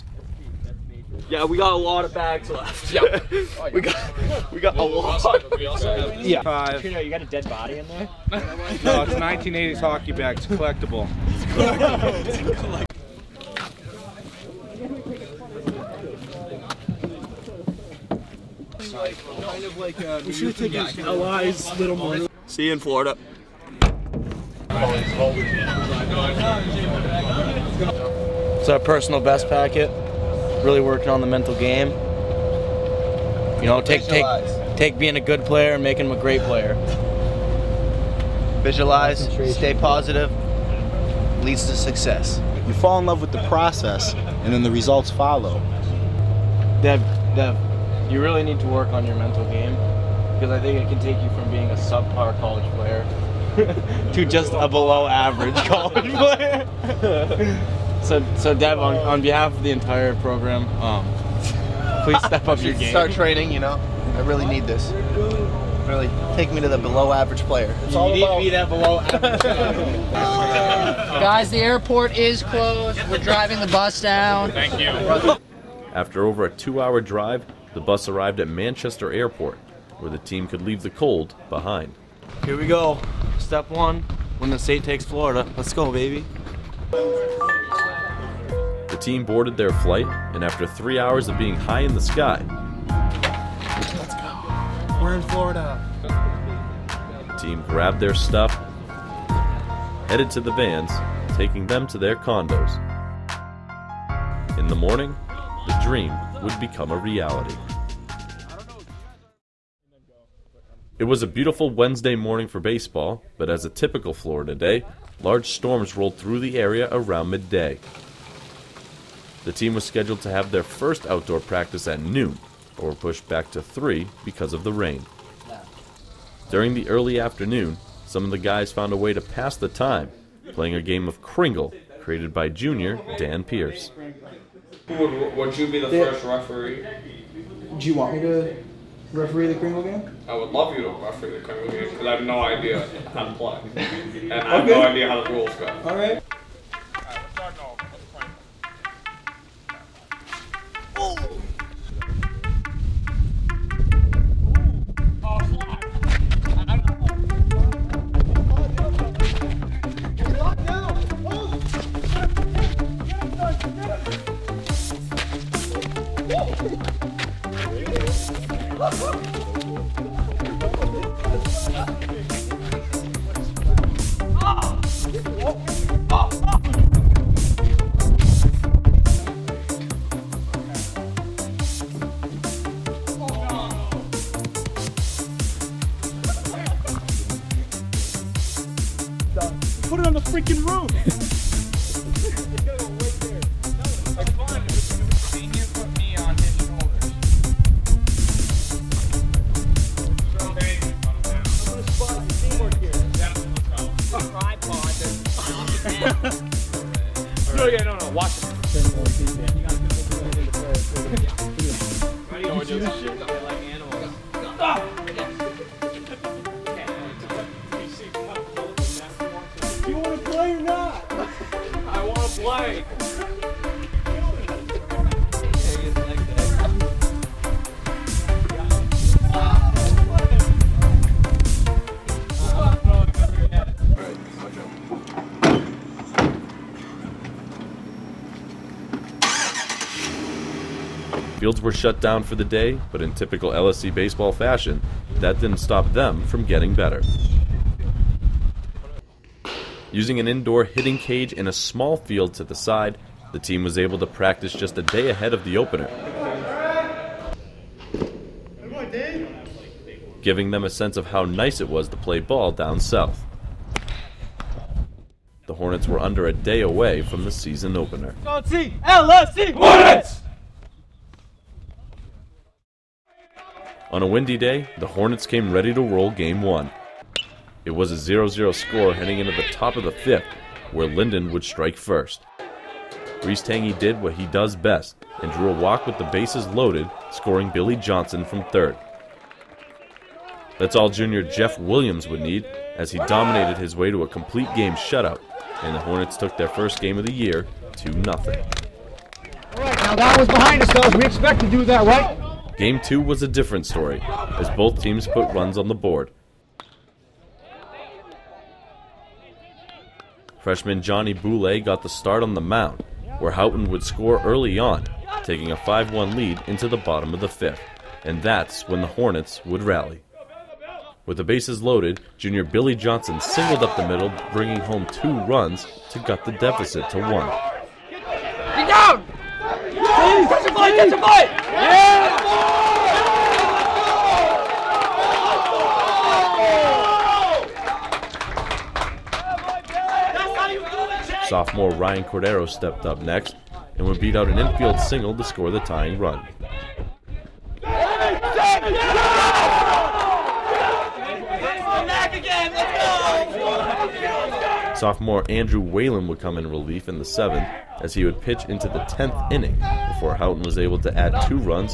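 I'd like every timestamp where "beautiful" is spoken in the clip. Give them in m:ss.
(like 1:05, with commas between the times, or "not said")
1:51.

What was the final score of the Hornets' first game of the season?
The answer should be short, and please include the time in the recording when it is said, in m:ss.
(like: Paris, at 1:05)
2-0, at 4:57.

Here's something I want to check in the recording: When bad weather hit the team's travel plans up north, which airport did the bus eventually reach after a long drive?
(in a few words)
Manchester Airport.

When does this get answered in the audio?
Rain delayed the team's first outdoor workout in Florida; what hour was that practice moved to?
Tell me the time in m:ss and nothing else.
2:03.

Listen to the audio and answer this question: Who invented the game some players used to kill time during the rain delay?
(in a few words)
Dan Pierce.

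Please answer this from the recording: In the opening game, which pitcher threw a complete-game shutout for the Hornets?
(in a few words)
Jeff Williams.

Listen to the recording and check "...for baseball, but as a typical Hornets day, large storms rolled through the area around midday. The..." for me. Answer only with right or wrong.
wrong.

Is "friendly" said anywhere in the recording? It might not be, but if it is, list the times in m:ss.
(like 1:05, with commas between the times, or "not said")
not said.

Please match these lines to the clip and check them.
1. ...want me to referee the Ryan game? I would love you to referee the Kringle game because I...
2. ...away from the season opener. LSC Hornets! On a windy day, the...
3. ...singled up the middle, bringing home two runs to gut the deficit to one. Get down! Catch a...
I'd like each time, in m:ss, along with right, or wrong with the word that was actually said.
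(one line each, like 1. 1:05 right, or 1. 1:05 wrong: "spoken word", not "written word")
1. 2:17 wrong: "Kringle", not "Ryan"
2. 4:26 right
3. 5:23 right.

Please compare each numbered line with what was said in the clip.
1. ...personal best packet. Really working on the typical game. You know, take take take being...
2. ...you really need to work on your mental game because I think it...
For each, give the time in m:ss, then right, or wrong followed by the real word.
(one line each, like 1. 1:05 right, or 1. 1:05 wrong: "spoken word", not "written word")
1. 0:28 wrong: "mental", not "typical"
2. 0:48 right.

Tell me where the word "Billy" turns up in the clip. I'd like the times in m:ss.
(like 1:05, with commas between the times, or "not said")
4:47, 5:22.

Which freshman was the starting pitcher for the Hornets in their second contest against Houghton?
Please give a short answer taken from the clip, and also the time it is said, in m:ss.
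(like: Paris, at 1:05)
Johnny Boulay, at 5:10.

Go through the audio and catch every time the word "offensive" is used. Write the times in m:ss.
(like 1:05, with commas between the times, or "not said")
not said.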